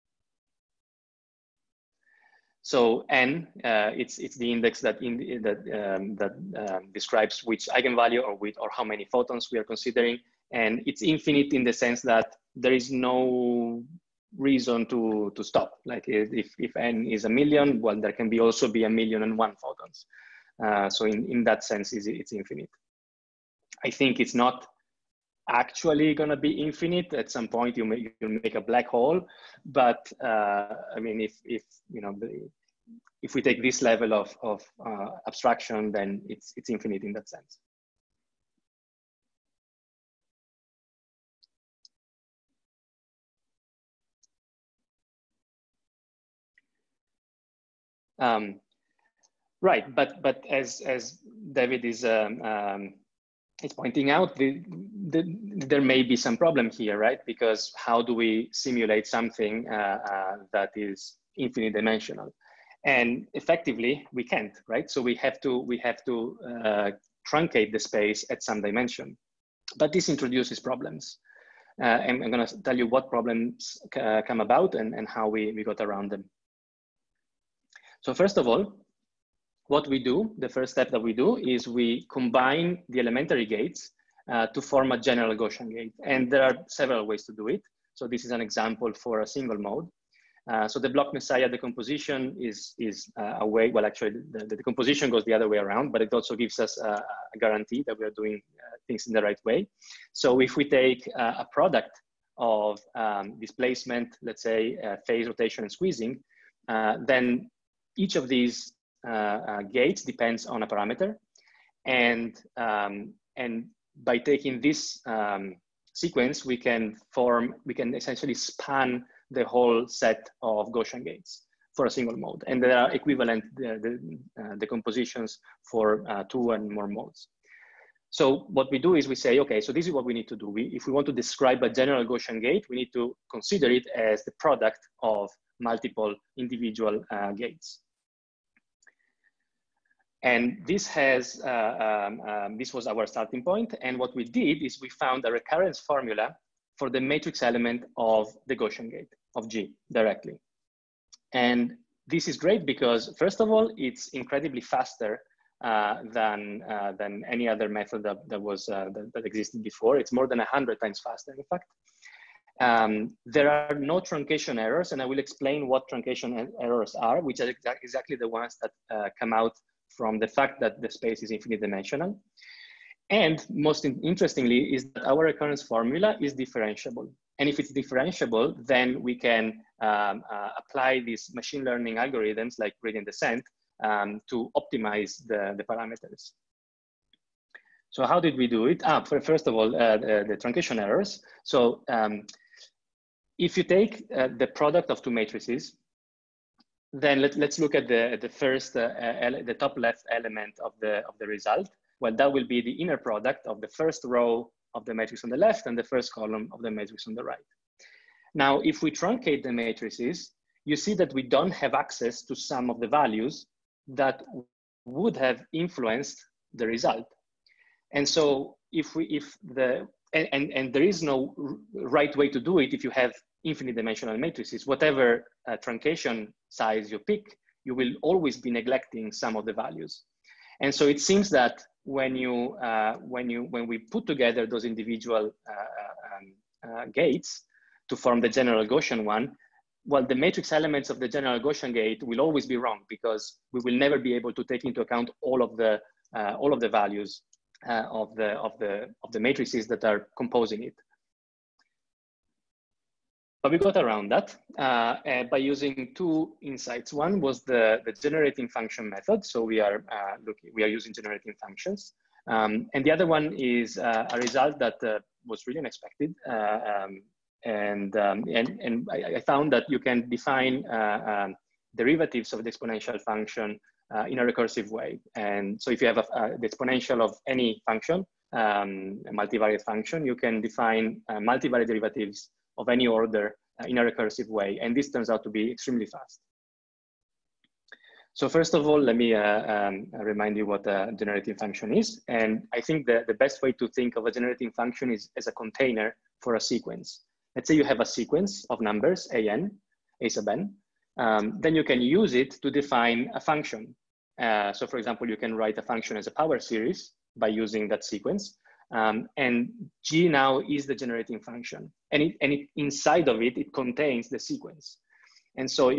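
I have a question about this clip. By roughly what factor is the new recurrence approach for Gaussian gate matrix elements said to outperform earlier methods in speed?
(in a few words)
more than 100 times.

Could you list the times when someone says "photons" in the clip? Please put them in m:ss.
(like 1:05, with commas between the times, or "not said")
0:09, 0:19.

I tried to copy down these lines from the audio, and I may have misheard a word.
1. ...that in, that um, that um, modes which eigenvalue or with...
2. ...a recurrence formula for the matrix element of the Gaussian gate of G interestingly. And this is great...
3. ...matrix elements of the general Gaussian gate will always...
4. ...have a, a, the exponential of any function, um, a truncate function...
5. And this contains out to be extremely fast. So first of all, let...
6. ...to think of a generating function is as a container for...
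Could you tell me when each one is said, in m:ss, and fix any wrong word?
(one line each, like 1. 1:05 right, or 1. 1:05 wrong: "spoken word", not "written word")
1. 0:04 wrong: "describes", not "modes"
2. 2:25 wrong: "directly", not "interestingly"
3. 4:00 right
4. 4:35 wrong: "multivariate", not "truncate"
5. 4:44 wrong: "turns", not "contains"
6. 4:53 right.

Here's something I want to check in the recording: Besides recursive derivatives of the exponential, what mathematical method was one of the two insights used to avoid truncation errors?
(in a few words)
generating function method.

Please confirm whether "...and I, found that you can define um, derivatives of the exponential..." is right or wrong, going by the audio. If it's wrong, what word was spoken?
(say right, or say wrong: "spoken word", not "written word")
right.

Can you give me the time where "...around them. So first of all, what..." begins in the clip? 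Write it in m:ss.
1:15.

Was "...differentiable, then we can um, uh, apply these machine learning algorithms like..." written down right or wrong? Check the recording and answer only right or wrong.
right.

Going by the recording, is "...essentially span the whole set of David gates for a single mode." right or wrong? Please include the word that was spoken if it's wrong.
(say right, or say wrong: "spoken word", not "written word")
wrong: "Gaussian", not "David".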